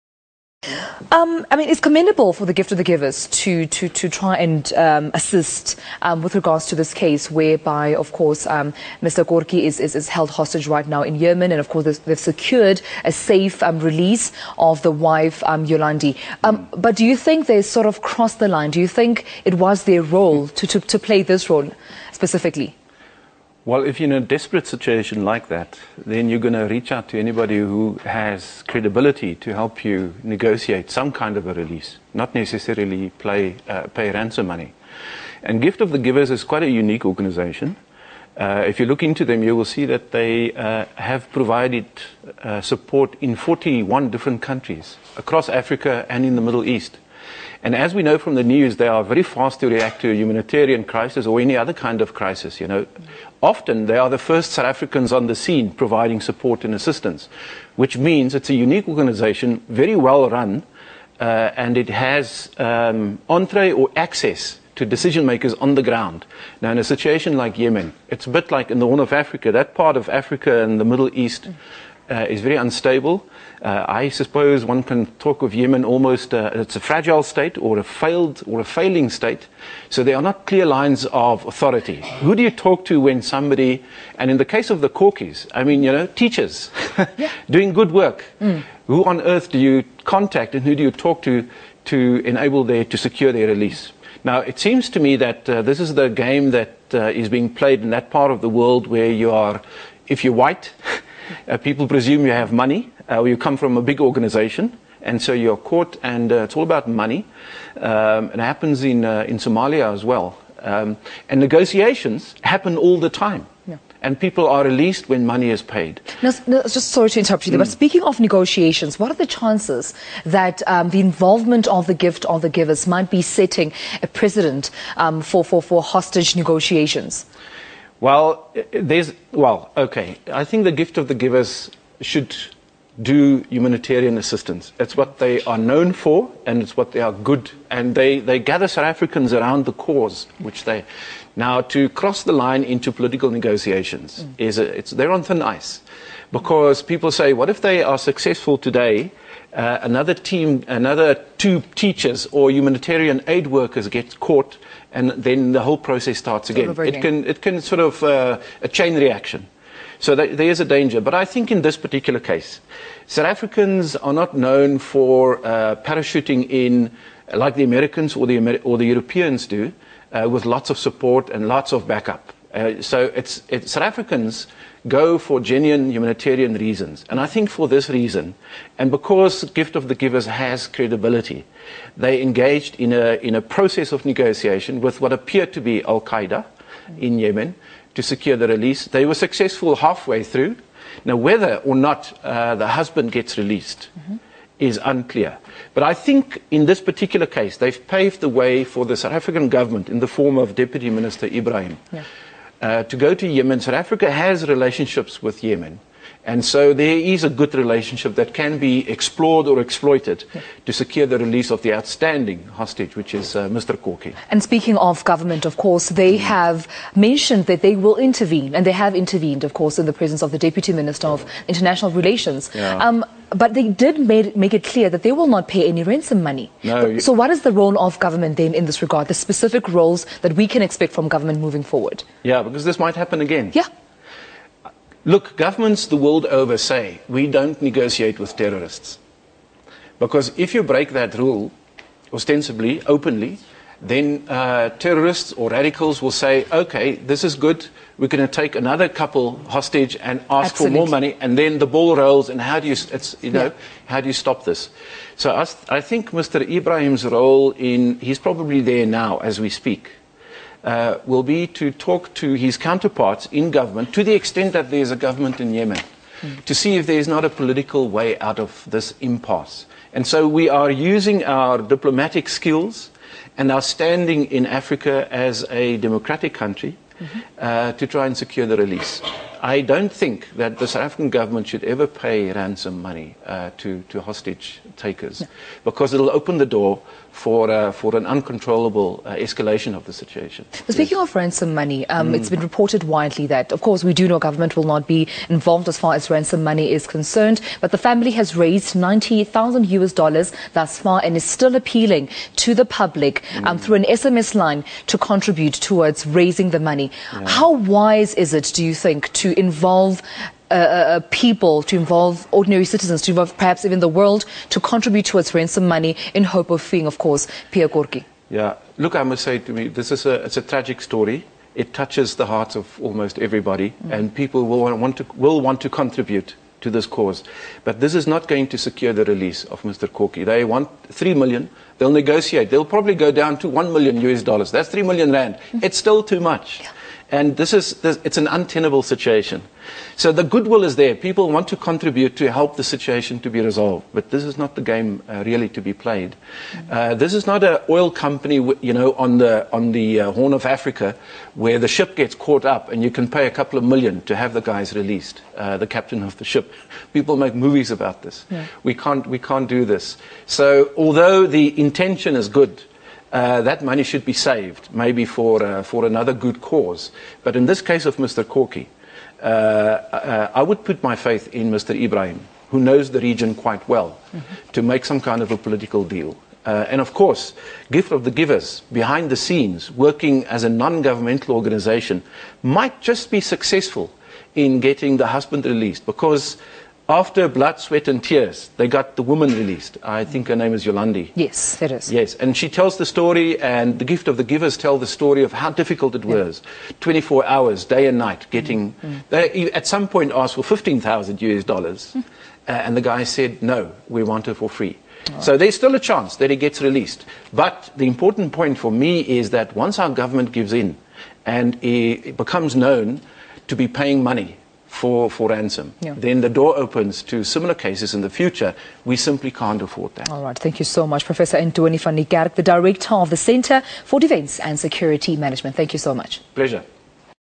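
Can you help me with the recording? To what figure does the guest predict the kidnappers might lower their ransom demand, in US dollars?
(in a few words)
$1 million.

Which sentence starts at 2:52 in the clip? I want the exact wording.
Uh, so it's, it's, South Africans go for genuine humanitarian reasons.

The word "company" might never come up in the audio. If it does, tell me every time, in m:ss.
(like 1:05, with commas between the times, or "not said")
5:47.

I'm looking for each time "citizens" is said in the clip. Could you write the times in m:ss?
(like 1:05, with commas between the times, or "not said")
5:12.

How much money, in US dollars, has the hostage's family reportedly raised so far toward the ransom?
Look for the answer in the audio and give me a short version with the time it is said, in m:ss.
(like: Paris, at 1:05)
$90,000, at 4:58.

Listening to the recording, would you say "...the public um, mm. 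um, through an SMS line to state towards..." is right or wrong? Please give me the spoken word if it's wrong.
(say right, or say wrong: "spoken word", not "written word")
wrong: "contribute", not "state".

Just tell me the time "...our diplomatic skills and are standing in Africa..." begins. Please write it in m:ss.
4:31.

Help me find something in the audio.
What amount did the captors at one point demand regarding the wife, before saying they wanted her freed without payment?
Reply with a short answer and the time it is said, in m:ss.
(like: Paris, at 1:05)
$15,000, at 6:40.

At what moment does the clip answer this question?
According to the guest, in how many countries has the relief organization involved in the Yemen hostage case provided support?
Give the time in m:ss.
0:43.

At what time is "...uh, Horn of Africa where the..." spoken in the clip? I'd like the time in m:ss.
5:49.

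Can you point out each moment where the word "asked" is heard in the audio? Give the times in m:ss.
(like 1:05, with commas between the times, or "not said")
6:40.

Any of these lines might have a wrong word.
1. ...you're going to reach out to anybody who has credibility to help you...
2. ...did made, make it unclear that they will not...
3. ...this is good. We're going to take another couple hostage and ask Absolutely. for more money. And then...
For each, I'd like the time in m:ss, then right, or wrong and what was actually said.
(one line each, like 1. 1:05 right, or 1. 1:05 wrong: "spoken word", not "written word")
1. 0:26 right
2. 3:43 wrong: "clear", not "unclear"
3. 4:06 right.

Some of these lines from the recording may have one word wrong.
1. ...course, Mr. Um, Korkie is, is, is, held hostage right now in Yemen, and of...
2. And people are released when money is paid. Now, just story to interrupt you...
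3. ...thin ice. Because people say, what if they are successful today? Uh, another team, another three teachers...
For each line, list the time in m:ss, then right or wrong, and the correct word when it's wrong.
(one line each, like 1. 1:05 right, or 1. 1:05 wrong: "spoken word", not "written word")
1. 0:08 right
2. 1:54 wrong: "sorry", not "story"
3. 2:25 wrong: "two", not "three".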